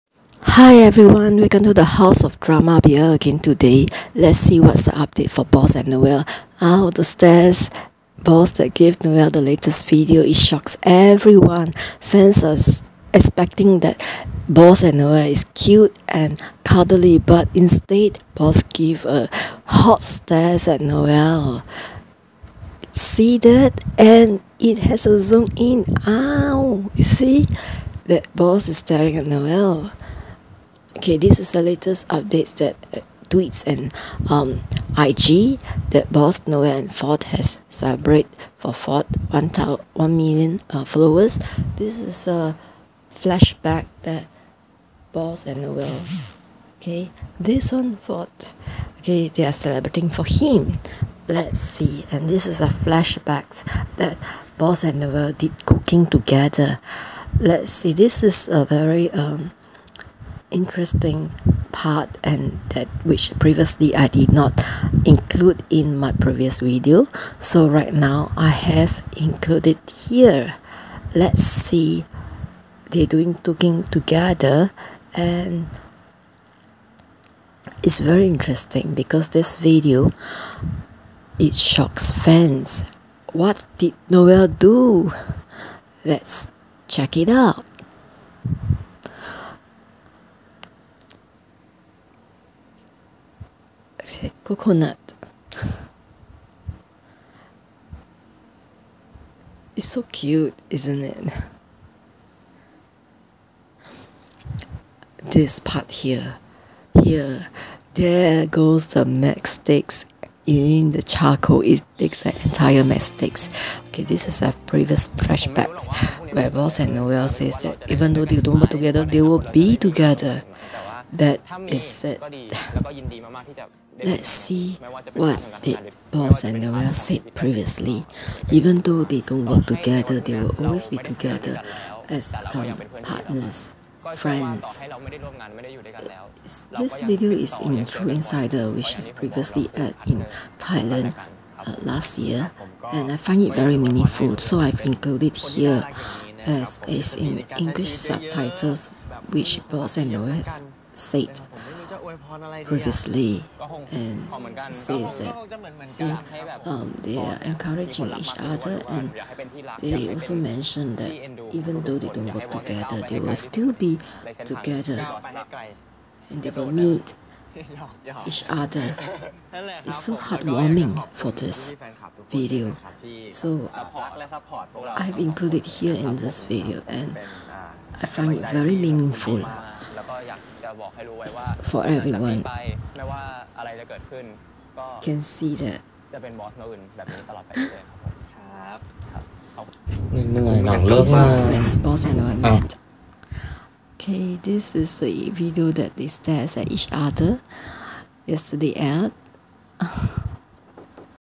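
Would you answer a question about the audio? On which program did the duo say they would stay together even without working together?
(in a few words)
True Insider.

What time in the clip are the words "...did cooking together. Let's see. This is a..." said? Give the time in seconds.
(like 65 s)
55 s.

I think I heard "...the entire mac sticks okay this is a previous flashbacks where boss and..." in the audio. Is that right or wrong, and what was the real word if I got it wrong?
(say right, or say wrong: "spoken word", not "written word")
right.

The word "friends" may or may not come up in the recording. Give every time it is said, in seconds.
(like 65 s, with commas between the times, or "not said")
134 s.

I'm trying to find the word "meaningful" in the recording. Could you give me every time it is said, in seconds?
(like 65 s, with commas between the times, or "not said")
143 s, 178 s.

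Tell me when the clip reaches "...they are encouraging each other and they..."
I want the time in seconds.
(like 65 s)
157 s.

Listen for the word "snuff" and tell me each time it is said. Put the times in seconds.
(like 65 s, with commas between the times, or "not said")
not said.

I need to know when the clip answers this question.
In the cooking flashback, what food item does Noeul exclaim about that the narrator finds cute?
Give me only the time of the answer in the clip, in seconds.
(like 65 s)
94 s.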